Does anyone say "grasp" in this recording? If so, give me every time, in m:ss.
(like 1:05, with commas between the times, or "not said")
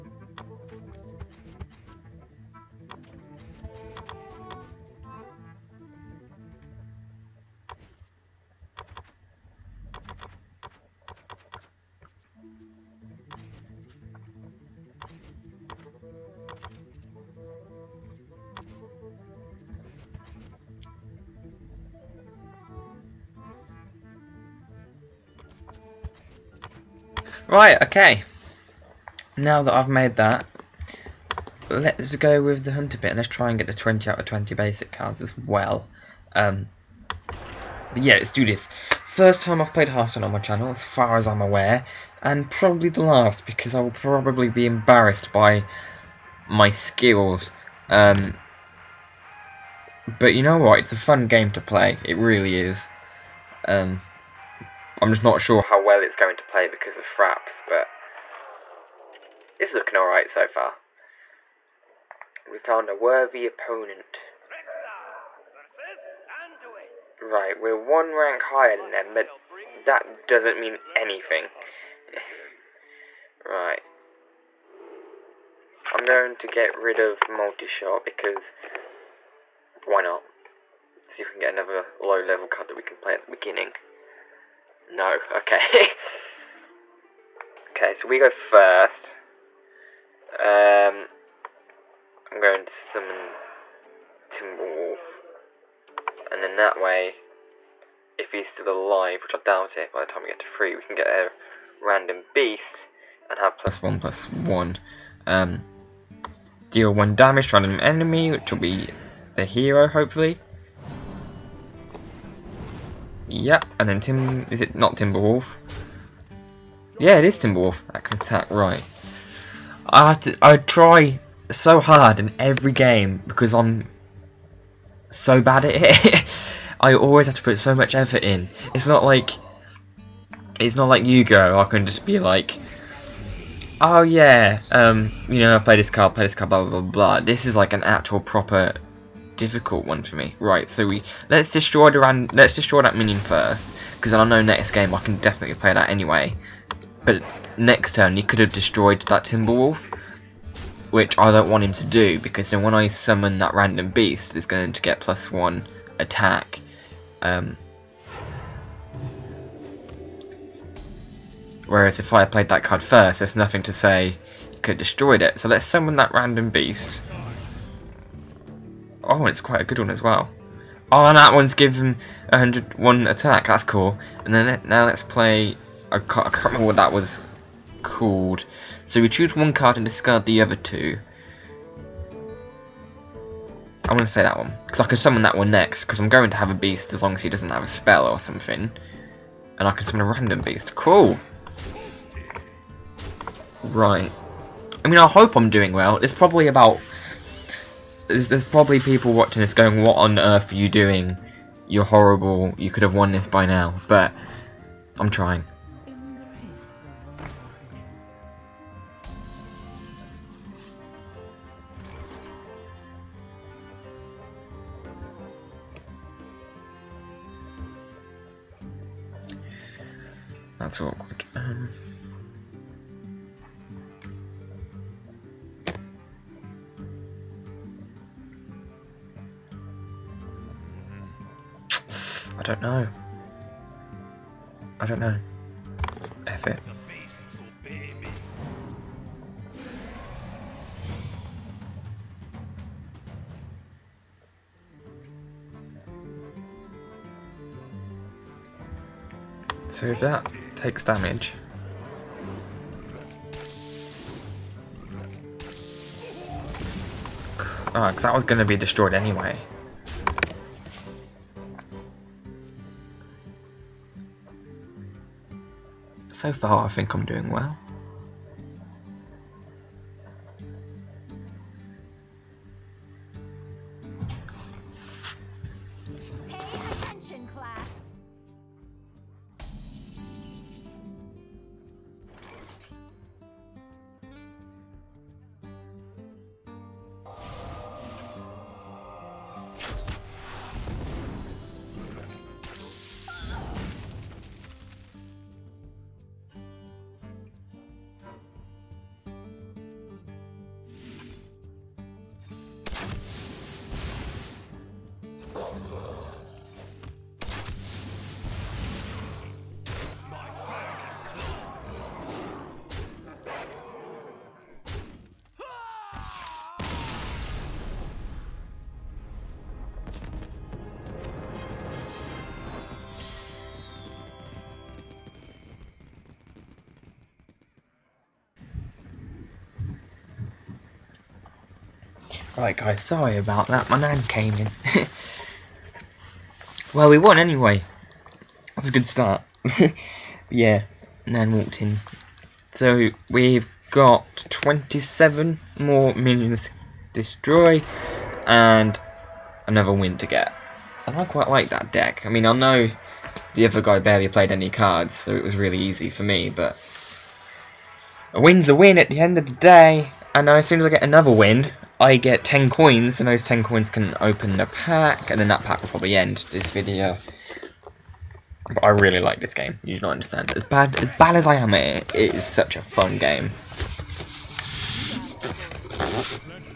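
not said.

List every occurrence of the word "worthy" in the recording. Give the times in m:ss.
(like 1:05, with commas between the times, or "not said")
1:02.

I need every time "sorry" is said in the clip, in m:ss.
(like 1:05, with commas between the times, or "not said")
5:32.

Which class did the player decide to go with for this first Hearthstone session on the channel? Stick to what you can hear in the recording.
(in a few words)
Hunter.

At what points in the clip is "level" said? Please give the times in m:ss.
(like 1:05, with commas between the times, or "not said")
1:22.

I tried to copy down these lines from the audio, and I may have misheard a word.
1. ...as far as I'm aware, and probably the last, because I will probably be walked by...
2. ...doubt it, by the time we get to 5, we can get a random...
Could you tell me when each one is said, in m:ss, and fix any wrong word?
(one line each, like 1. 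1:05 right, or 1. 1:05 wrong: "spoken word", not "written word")
1. 0:40 wrong: "embarrassed", not "walked"
2. 1:39 wrong: "3", not "5".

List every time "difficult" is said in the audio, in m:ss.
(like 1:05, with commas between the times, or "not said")
2:19.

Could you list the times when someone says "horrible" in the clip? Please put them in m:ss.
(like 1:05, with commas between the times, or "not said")
3:21.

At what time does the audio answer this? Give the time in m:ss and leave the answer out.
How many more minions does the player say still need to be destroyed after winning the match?
5:44.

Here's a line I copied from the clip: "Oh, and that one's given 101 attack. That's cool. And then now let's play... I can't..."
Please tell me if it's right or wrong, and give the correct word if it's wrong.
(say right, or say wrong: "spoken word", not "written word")
right.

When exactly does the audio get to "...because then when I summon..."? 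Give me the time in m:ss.
2:32.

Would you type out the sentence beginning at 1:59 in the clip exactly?
I, have to, I try so hard in every game because I'm so bad at it.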